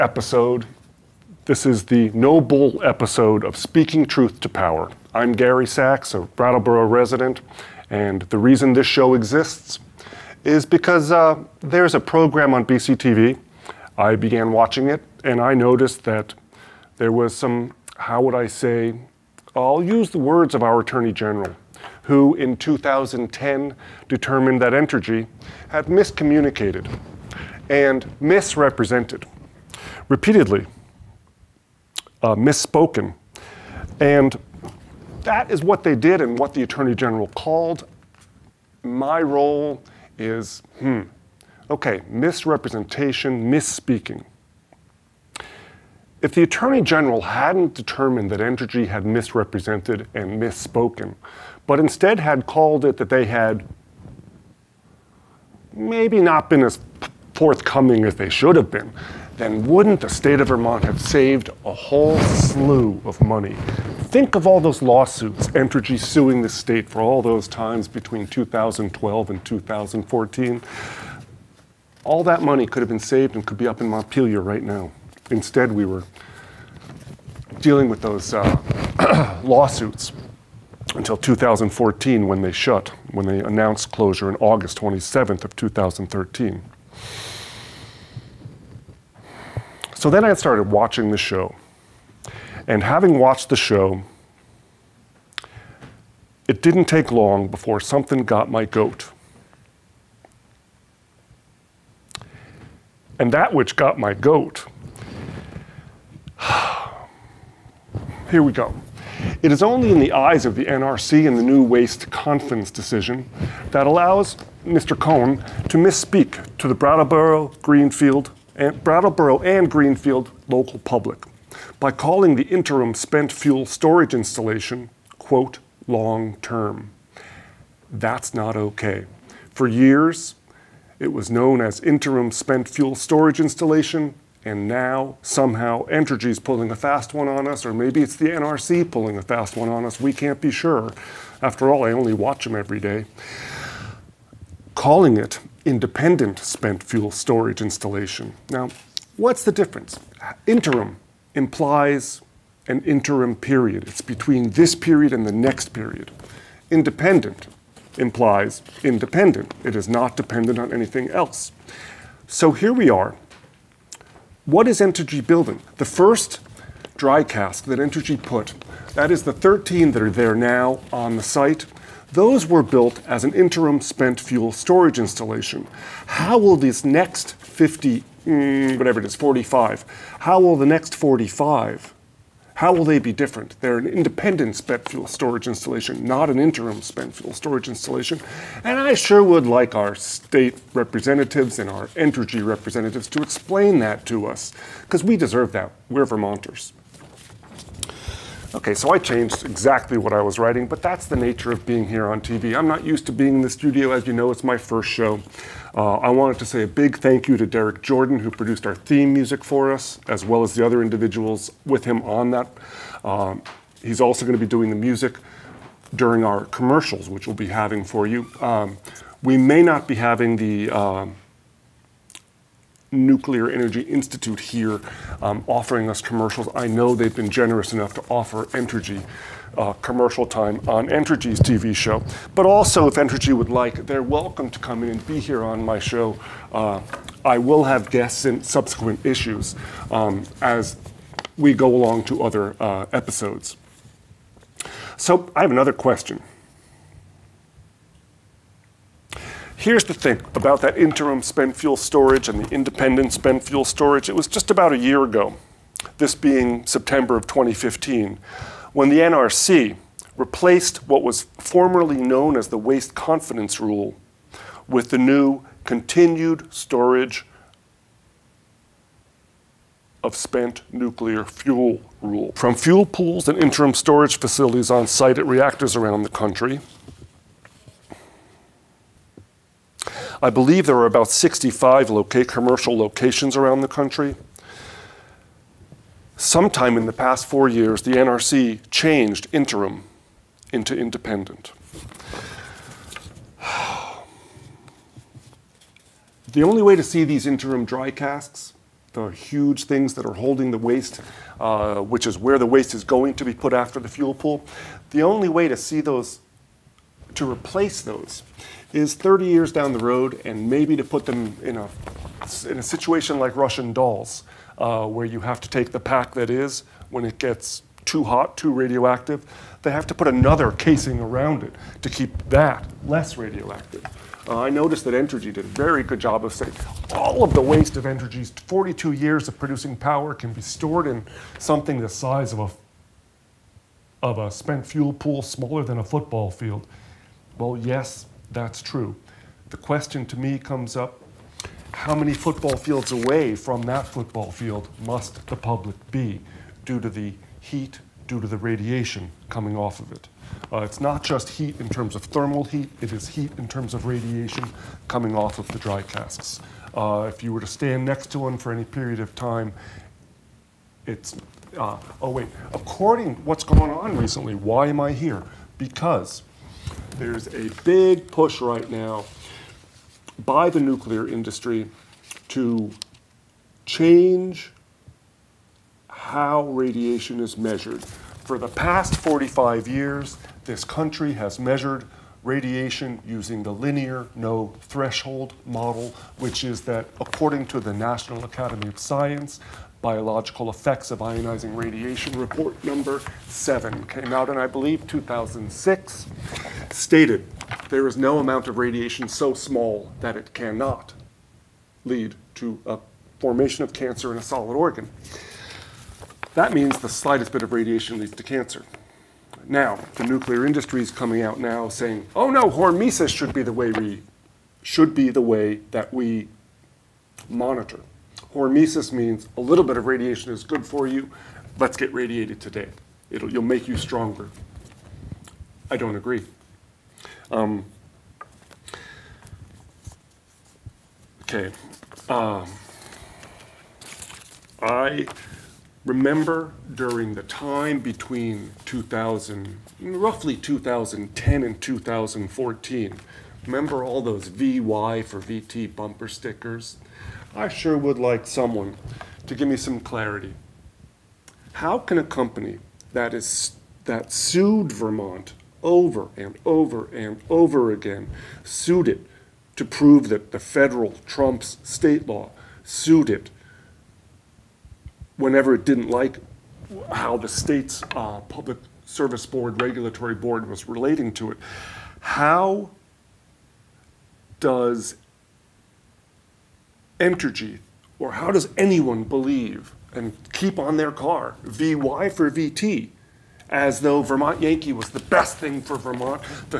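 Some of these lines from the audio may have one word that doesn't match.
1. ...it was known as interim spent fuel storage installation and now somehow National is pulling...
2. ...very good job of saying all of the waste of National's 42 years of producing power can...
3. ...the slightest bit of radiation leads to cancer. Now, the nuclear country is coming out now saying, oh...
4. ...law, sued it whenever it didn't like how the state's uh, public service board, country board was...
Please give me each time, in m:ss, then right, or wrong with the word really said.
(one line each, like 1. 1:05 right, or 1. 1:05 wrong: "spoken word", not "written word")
1. 2:10 wrong: "Entergy", not "National"
2. 5:25 wrong: "Entergy", not "National"
3. 6:46 wrong: "industry", not "country"
4. 7:42 wrong: "regulatory", not "country".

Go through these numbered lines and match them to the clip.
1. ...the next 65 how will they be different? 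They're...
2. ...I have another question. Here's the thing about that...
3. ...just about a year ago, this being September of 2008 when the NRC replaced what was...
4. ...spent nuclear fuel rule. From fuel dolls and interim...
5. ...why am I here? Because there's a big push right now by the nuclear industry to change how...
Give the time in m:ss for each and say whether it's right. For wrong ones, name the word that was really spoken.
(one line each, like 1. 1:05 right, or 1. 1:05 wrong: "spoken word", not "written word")
1. 3:00 wrong: "45", not "65"
2. 4:05 right
3. 4:14 wrong: "2015", not "2008"
4. 4:30 wrong: "pools", not "dolls"
5. 6:04 right.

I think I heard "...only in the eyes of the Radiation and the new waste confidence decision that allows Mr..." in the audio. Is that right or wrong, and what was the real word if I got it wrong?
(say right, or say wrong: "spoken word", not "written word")
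wrong: "NRC", not "Radiation".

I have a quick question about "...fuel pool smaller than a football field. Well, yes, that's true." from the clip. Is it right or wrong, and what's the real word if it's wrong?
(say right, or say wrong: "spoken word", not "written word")
right.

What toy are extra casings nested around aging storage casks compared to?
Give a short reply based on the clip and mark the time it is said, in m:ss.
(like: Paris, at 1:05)
Russian dolls, at 5:13.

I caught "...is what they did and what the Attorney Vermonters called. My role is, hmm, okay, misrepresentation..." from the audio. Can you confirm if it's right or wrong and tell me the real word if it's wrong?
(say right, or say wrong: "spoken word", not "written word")
wrong: "General", not "Vermonters".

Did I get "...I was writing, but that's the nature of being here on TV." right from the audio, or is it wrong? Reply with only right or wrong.
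right.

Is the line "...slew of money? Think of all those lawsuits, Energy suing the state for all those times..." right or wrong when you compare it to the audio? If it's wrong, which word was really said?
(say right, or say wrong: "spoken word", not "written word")
wrong: "Entergy", not "Energy".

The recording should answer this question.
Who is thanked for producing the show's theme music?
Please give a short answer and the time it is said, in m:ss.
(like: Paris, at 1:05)
Derek Jordan, at 3:27.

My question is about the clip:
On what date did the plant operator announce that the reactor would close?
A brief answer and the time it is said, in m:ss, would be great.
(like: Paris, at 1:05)
August 27th, at 1:24.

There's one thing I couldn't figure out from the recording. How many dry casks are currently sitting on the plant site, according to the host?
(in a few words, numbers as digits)
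13.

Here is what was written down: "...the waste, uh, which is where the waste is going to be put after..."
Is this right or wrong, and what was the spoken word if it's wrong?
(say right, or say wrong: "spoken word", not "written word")
right.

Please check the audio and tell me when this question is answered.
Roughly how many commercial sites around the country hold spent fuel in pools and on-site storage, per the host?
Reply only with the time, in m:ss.
4:41.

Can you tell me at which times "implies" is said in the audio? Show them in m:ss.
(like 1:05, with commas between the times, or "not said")
2:31, 2:37.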